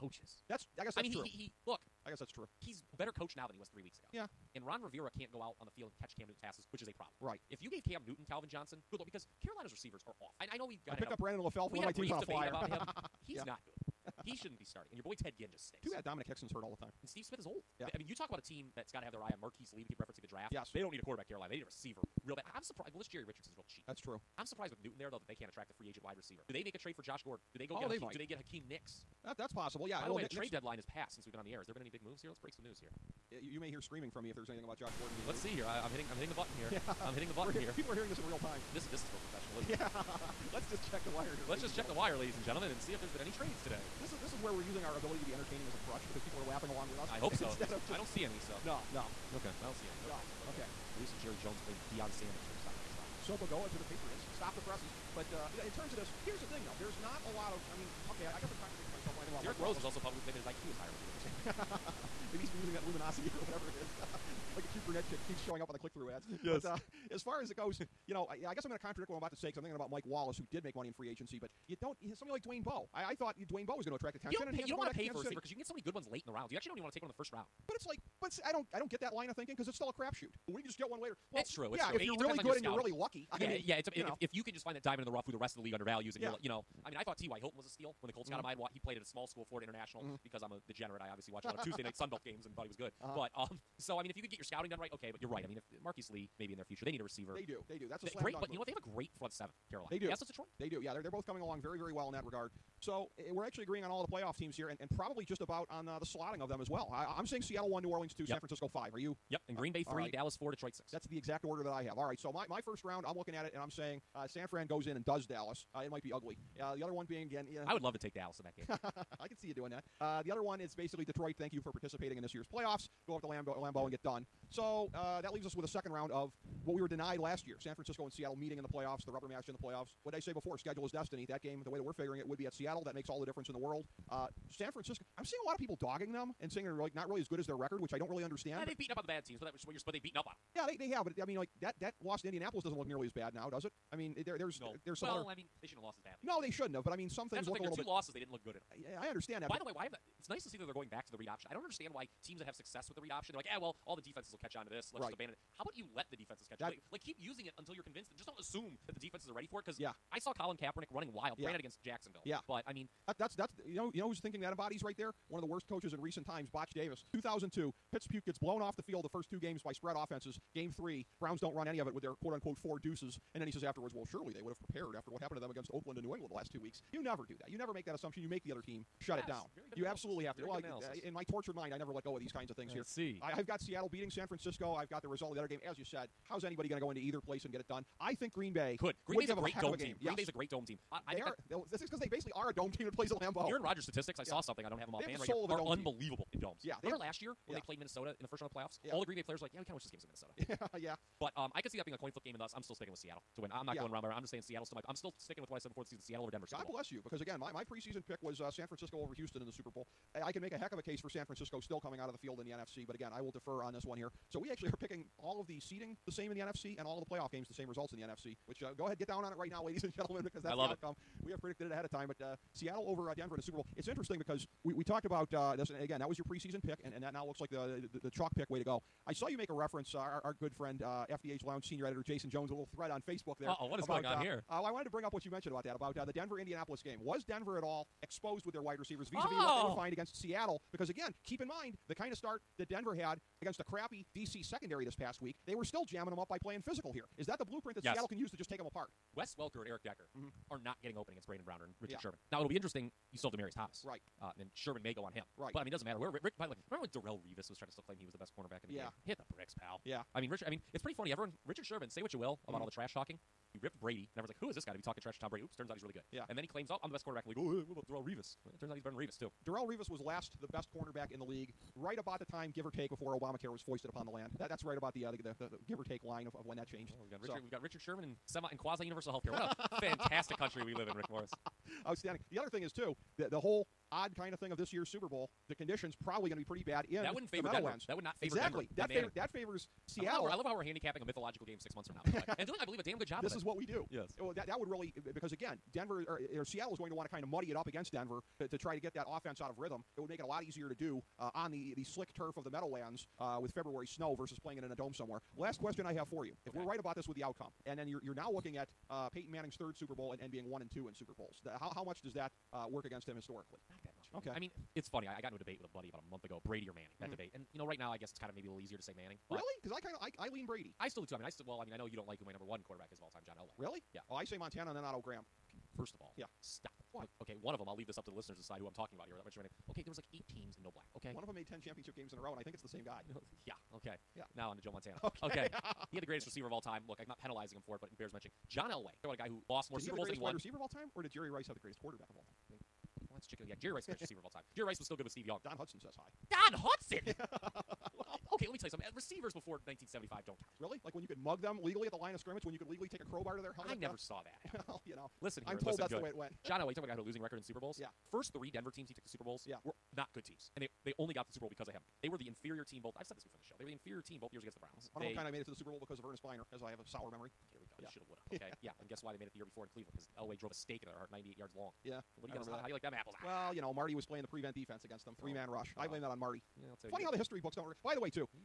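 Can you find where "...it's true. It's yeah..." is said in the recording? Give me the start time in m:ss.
1:21.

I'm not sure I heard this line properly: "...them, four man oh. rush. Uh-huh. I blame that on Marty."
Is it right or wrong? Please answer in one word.
wrong.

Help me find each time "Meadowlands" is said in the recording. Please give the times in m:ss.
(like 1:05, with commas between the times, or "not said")
4:47, 5:02.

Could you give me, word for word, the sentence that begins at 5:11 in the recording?
The, how how much does that uh, work against him historically?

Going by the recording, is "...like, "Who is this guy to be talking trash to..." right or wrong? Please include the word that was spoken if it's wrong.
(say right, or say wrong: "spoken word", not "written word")
right.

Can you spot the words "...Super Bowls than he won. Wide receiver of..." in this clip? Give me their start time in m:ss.
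5:39.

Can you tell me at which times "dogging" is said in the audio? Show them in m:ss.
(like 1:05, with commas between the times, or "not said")
2:15.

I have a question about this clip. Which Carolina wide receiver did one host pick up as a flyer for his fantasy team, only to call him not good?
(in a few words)
Brandon LaFell.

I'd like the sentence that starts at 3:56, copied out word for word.
Was Denver at all exposed with their wide receivers vis-a-vis what they would oh!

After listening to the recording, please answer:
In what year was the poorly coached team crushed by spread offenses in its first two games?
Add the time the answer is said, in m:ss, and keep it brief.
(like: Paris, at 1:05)
2002, at 2:47.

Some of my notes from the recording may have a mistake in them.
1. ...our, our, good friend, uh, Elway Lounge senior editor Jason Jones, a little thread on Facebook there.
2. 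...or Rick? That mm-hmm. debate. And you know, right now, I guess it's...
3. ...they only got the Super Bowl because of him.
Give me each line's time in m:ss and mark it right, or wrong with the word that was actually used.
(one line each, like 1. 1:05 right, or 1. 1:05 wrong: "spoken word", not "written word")
1. 3:49 wrong: "FDH", not "Elway"
2. 5:16 wrong: "Manning", not "Rick"
3. 6:00 right.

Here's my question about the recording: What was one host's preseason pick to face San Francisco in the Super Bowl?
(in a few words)
Houston.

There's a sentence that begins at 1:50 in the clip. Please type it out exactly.
That's the exact order that I have.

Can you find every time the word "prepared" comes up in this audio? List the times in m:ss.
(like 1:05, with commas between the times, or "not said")
2:54.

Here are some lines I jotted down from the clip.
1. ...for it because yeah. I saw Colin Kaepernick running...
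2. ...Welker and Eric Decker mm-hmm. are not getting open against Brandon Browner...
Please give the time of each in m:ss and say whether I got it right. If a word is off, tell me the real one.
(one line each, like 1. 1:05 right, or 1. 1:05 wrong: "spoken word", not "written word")
1. 2:39 right
2. 4:09 right.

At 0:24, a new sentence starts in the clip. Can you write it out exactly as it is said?
I'm surprised with Newton there though that they can't attract a free agent wide receiver.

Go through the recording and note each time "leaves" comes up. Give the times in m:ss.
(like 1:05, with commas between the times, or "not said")
2:05, 5:27.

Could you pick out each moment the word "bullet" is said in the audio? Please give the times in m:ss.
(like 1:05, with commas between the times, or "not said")
not said.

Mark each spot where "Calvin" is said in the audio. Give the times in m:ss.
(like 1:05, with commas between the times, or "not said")
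0:08.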